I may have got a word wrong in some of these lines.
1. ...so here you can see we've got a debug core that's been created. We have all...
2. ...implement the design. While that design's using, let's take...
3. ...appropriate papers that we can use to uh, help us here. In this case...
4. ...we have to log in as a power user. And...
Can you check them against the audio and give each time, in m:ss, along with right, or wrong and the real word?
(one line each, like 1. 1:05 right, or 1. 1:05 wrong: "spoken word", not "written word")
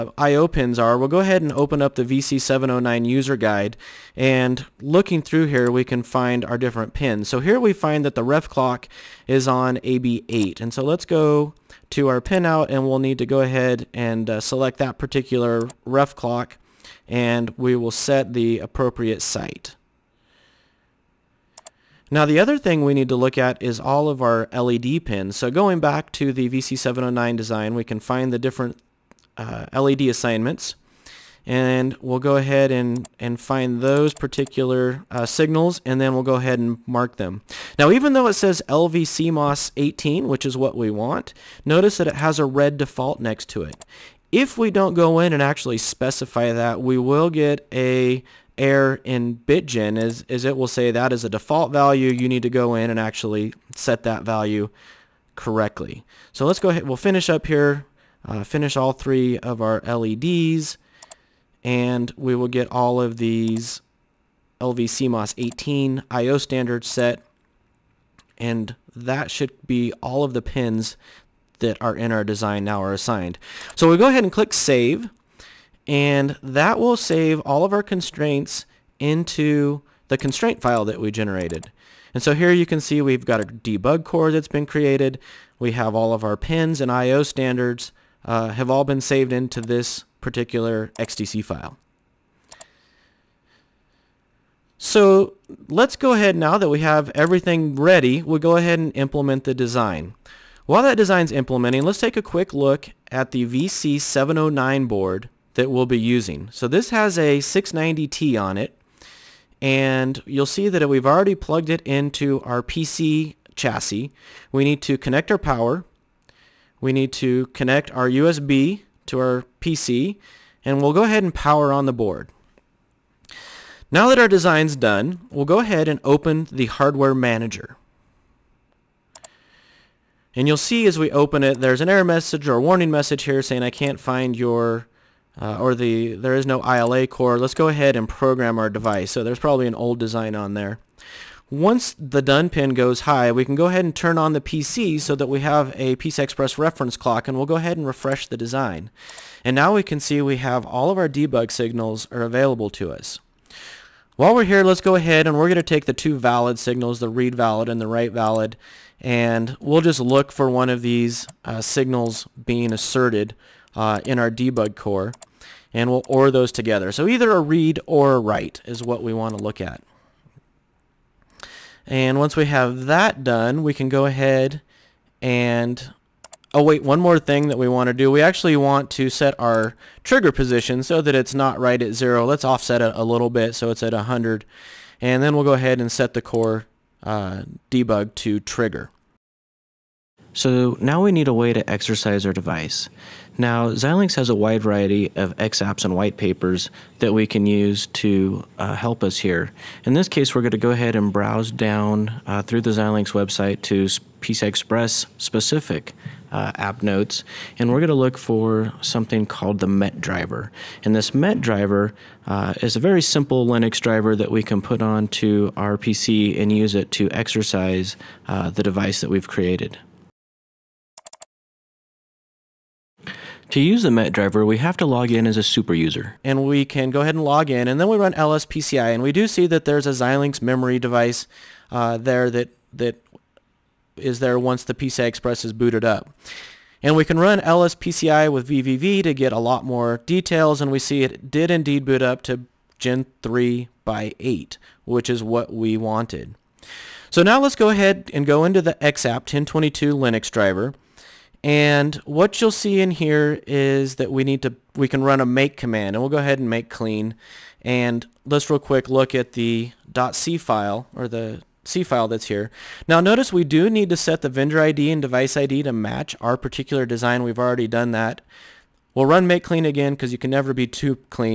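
1. 1:22 right
2. 1:38 wrong: "implementing", not "using"
3. 3:15 wrong: "white", not "appropriate"
4. 3:44 wrong: "super", not "power".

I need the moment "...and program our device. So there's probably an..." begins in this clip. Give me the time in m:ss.
2:17.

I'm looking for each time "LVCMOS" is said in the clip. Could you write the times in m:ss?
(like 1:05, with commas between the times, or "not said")
0:38, 1:04.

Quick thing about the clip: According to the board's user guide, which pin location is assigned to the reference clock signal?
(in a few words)
AB8.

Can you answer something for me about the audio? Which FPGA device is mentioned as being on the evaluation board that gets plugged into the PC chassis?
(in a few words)
690T.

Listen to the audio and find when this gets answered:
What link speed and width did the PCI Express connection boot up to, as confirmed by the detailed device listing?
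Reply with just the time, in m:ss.
4:02.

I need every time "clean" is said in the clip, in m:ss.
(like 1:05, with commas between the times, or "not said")
4:16, 4:29.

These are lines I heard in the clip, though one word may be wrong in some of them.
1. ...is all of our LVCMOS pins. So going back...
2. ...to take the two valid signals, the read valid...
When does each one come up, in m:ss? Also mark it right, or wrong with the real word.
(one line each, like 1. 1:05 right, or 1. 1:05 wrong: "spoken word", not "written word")
1. 0:23 wrong: "LED", not "LVCMOS"
2. 2:35 right.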